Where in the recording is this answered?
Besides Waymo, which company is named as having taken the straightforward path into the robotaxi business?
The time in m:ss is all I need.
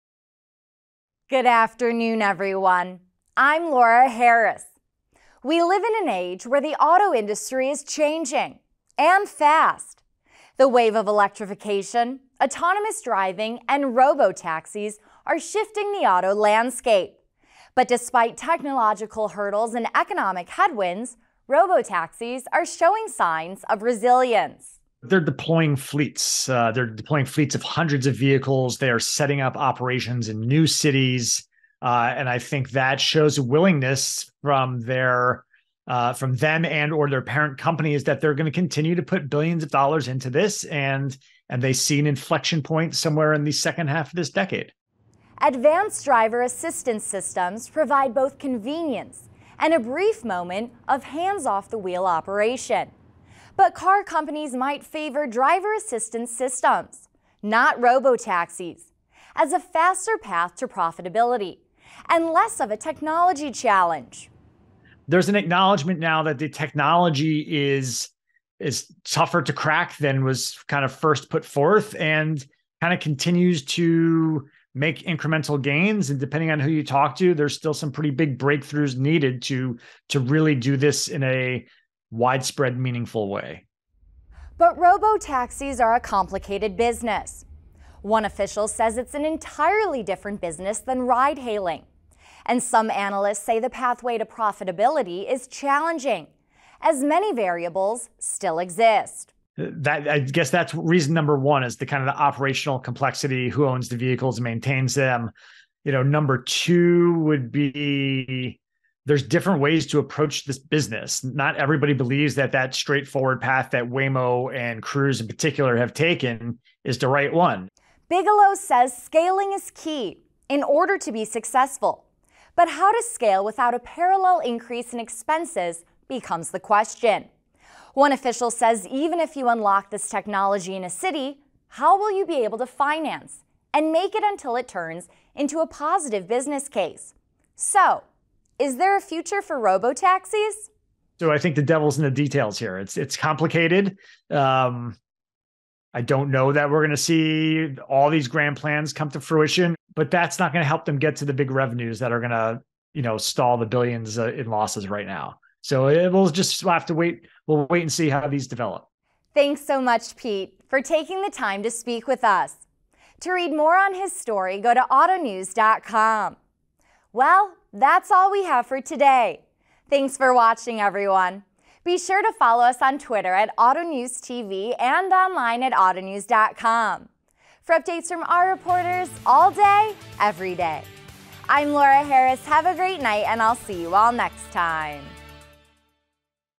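1:54.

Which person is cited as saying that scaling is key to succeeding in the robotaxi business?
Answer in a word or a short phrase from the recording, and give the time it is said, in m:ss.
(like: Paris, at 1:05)
Bigelow, at 1:58.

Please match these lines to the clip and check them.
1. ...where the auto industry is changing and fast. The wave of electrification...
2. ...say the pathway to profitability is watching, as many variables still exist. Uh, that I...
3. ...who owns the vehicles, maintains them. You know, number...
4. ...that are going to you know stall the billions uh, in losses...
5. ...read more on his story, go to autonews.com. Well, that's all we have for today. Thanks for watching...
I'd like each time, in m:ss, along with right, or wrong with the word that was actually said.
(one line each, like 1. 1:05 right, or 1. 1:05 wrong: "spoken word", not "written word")
1. 0:06 right
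2. 1:33 wrong: "challenging", not "watching"
3. 1:43 right
4. 2:31 right
5. 2:43 right.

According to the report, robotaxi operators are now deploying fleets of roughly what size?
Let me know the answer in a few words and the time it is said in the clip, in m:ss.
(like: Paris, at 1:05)
hundreds of vehicles, at 0:27.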